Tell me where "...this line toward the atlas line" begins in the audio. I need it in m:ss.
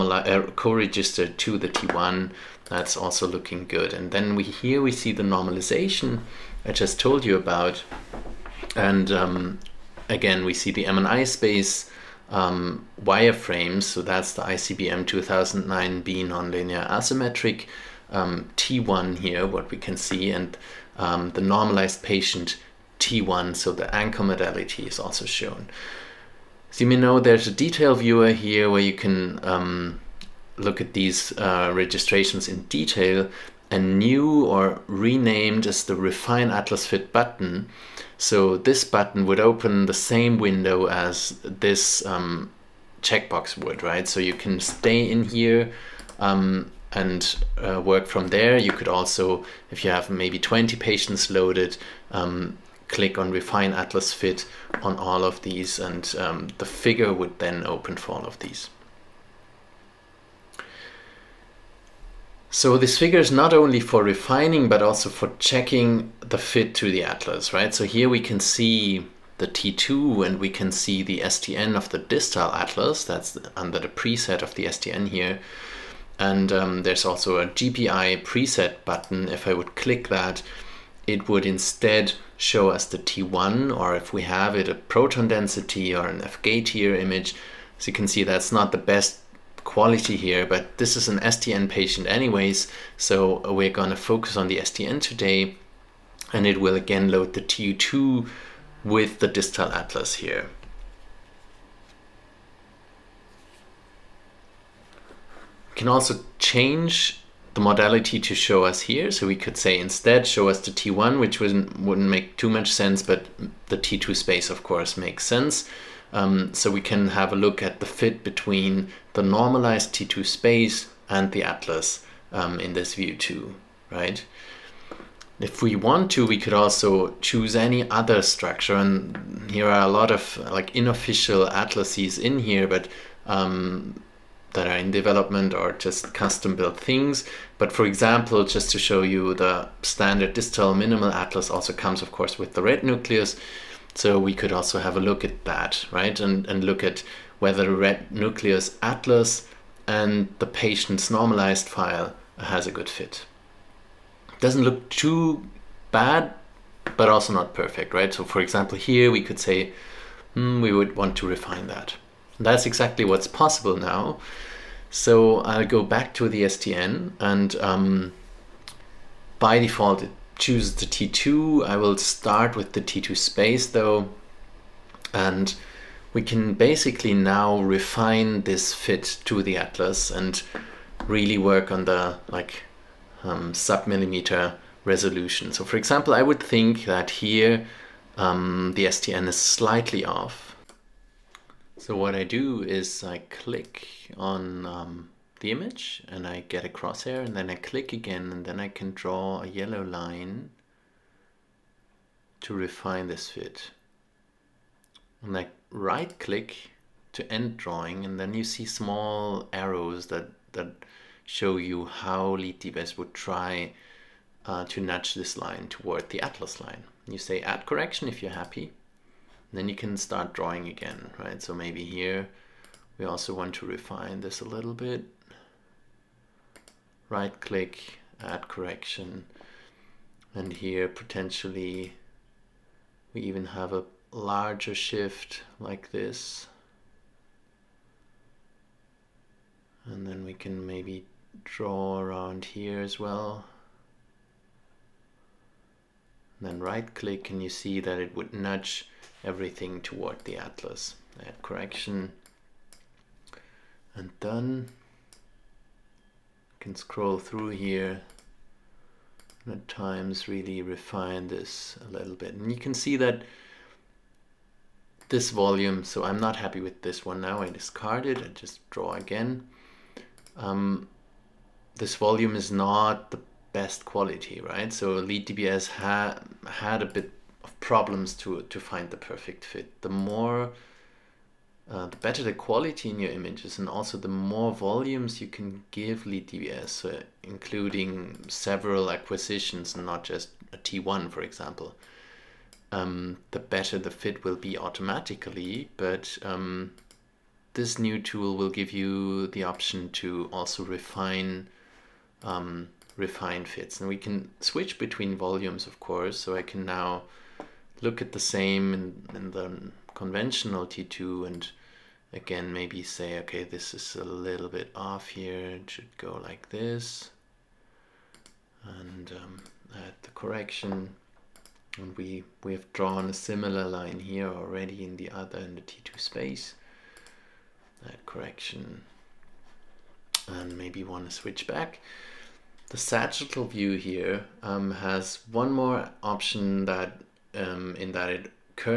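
3:35.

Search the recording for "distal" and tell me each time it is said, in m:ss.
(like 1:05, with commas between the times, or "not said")
1:11, 1:39, 2:20.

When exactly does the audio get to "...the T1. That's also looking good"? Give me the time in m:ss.
0:01.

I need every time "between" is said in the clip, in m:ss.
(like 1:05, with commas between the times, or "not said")
1:58, 5:04.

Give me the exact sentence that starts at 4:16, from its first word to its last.
You can scroll through here and at times really refine this a little bit.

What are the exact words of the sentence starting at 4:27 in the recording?
I discard it, I just draw again.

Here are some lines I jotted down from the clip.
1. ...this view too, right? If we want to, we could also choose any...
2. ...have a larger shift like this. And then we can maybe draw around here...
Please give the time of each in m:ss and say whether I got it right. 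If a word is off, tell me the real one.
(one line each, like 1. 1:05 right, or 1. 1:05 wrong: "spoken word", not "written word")
1. 2:02 right
2. 3:53 right.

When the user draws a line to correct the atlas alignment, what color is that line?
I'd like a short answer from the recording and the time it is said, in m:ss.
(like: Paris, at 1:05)
Yellow, at 3:19.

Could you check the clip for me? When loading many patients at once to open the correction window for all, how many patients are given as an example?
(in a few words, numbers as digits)
20.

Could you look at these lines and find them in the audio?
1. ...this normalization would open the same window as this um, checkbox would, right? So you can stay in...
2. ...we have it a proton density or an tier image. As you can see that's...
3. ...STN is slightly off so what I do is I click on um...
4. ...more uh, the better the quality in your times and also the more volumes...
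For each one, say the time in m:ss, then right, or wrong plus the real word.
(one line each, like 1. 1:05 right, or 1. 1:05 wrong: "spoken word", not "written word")
1. 0:38 wrong: "button", not "normalization"
2. 1:24 right
3. 3:08 right
4. 4:40 wrong: "images", not "times".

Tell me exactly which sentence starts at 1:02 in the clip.
So this figure is not only for refining but also for checking the fit to the atlas, right?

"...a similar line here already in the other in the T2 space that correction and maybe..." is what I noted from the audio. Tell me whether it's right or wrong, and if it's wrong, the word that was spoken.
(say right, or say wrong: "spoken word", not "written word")
right.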